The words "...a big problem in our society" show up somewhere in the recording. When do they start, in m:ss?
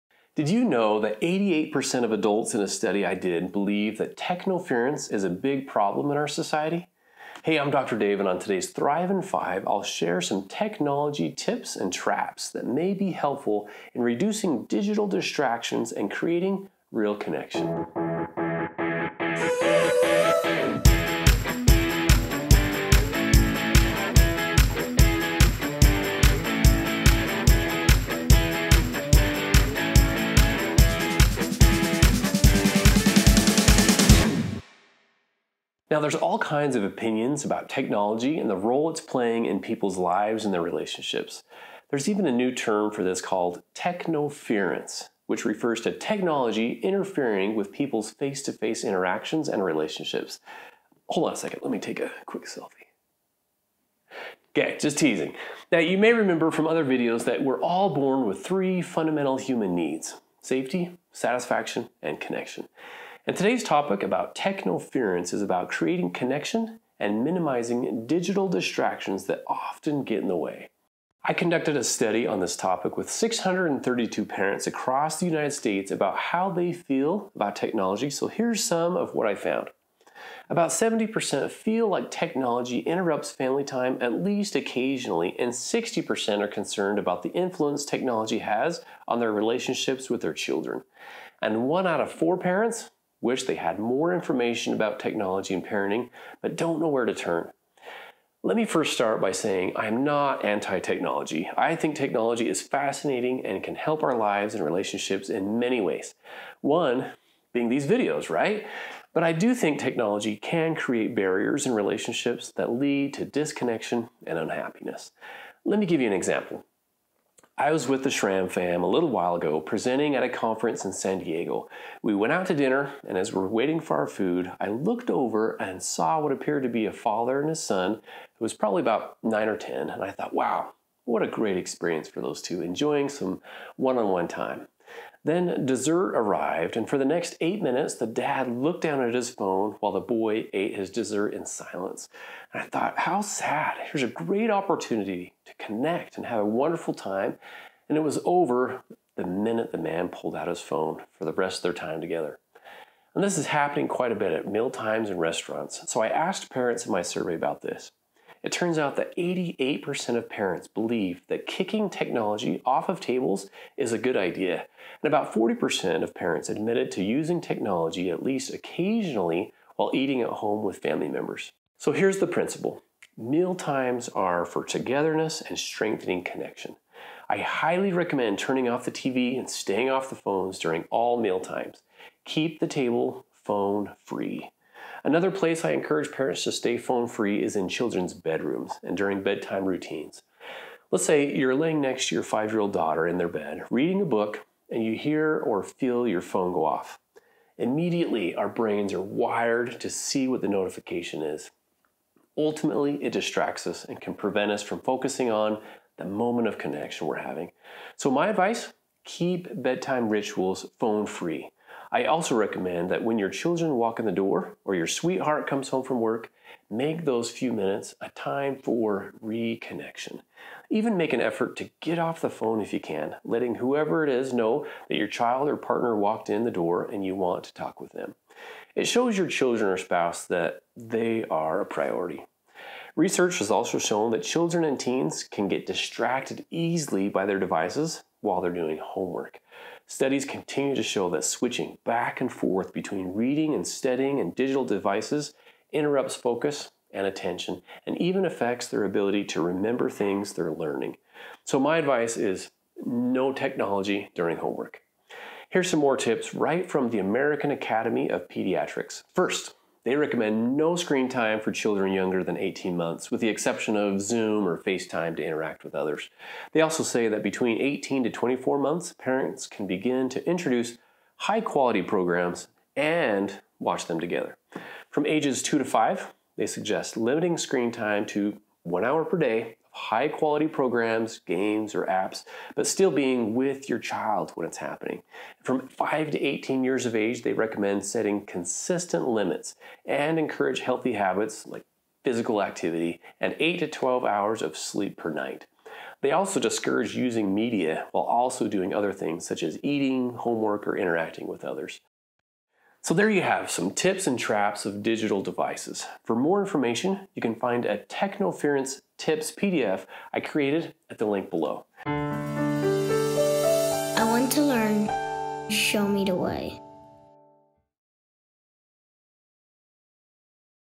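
0:05.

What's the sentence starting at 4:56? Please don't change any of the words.
They also discourage using media while also doing other things such as eating, homework, or interacting with others.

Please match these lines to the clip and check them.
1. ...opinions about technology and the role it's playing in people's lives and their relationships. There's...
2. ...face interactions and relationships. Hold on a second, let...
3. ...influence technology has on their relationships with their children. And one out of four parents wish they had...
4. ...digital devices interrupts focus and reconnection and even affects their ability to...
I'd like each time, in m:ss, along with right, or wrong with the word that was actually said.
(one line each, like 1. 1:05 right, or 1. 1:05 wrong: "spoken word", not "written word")
1. 0:36 right
2. 0:48 right
3. 1:27 right
4. 4:04 wrong: "attention", not "reconnection".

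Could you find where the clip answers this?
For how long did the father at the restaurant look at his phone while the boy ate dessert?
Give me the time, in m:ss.
2:17.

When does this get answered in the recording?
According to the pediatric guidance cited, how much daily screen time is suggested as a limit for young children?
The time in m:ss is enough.
4:38.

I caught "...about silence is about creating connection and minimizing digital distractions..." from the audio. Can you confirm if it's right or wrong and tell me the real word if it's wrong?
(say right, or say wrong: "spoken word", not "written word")
wrong: "technoference", not "silence".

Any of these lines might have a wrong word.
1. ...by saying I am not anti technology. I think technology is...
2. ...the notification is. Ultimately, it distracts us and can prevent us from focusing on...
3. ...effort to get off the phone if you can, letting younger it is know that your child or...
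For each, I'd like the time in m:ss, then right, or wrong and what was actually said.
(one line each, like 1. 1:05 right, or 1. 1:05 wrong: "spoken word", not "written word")
1. 1:39 right
2. 3:20 right
3. 3:41 wrong: "whoever", not "younger".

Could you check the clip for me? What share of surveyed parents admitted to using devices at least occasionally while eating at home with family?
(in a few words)
40%.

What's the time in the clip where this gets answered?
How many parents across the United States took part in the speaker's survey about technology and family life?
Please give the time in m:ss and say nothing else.
1:13.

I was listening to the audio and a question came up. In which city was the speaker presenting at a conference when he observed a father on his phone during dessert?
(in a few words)
San Diego.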